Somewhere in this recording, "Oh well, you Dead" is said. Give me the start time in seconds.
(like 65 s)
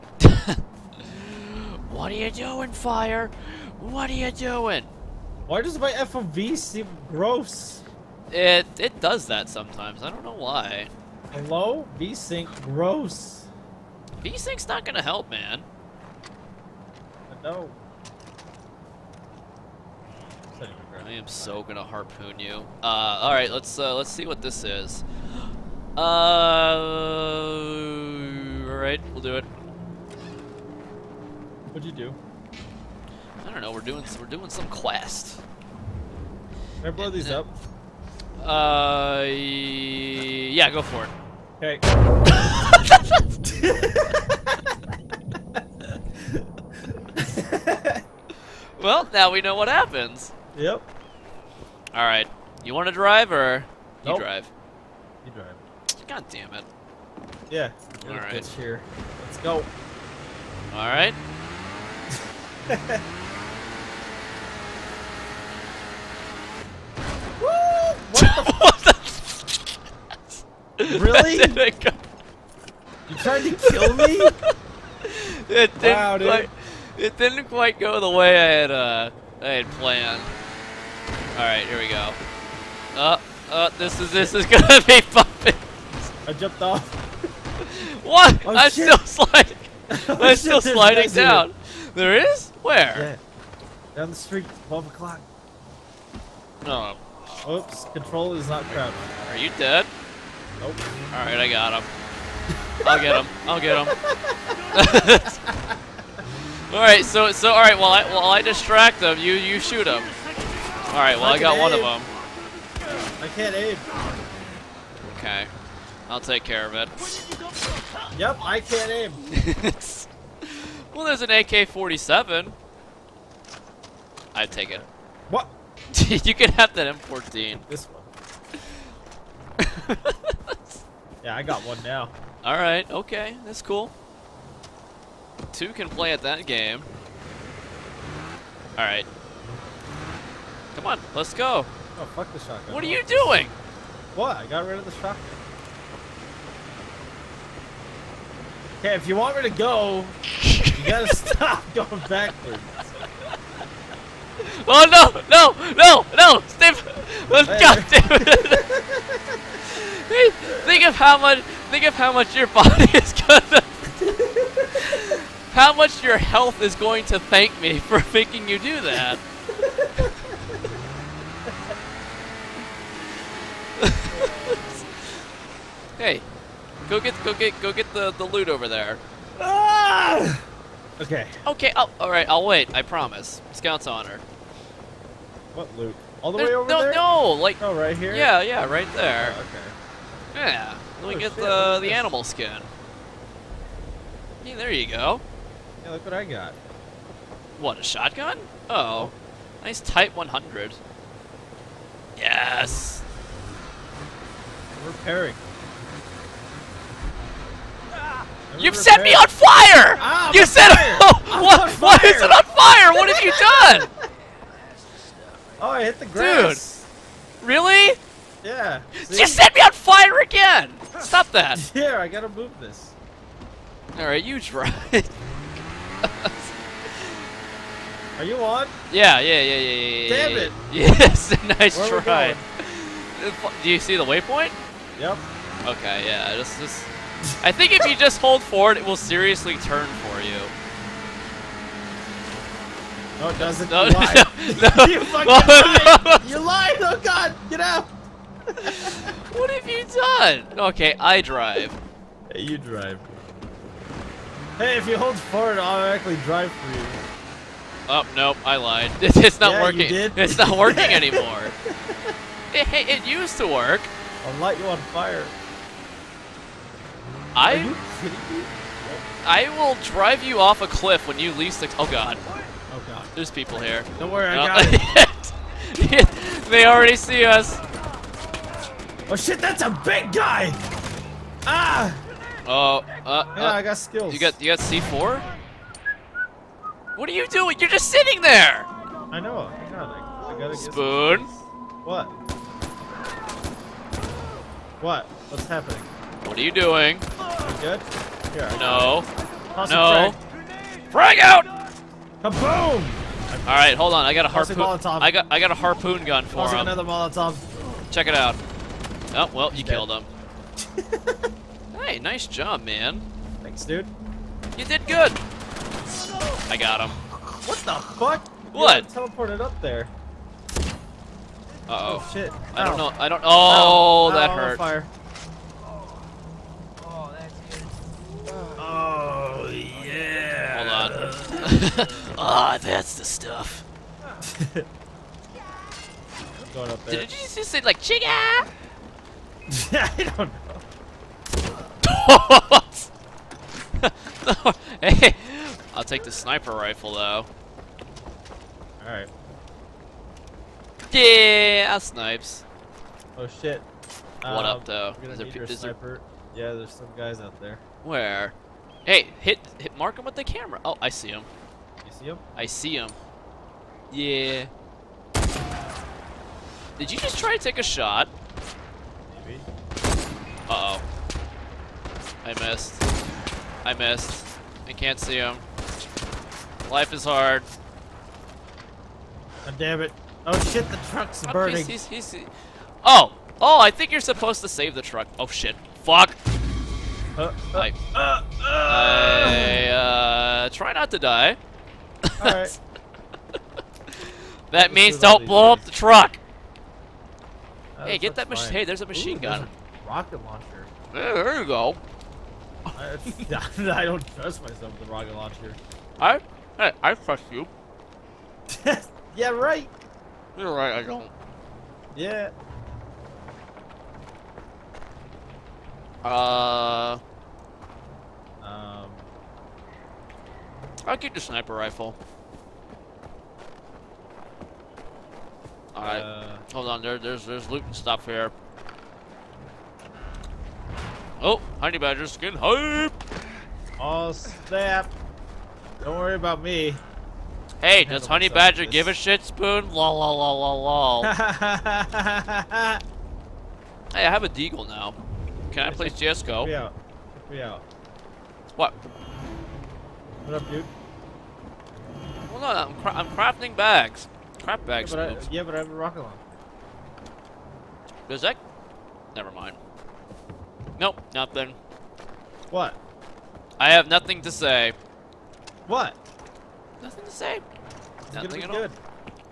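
309 s.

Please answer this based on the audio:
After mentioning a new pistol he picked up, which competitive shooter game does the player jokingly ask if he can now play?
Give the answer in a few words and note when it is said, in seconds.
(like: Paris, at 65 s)
CS:GO, at 445 s.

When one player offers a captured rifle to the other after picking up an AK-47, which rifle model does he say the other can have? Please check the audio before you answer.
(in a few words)
M14.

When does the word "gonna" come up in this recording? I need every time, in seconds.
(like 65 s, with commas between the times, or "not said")
14 s, 21 s, 84 s, 163 s.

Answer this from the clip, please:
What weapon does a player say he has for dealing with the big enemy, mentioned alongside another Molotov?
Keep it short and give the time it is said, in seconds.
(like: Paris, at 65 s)
harpoon gun, at 305 s.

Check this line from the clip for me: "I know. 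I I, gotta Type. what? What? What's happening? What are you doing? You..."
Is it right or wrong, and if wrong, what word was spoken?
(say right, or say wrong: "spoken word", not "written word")
wrong: "Spoon", not "Type".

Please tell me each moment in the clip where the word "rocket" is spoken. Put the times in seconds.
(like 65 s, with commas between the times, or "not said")
399 s, 404 s, 455 s.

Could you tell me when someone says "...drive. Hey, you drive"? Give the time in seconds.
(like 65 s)
251 s.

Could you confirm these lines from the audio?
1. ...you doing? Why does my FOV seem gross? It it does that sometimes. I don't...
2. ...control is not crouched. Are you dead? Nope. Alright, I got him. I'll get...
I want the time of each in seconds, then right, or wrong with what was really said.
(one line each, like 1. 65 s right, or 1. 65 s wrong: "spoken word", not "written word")
1. 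4 s right
2. 97 s right.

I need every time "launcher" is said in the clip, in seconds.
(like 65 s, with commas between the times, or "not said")
400 s, 405 s, 455 s.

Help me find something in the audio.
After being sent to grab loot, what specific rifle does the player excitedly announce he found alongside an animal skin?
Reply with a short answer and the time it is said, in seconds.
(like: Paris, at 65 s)
Type 100, at 199 s.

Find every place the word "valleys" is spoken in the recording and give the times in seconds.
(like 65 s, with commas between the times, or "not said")
not said.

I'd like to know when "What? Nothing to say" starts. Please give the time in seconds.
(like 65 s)
465 s.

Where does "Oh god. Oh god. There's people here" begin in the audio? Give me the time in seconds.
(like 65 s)
271 s.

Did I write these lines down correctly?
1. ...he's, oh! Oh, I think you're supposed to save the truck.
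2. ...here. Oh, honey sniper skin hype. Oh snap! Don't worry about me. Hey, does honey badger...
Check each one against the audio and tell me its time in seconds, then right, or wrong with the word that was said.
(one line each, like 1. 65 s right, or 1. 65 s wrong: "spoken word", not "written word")
1. 382 s right
2. 428 s wrong: "badger", not "sniper".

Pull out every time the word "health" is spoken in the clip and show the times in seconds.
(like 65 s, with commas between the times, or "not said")
166 s.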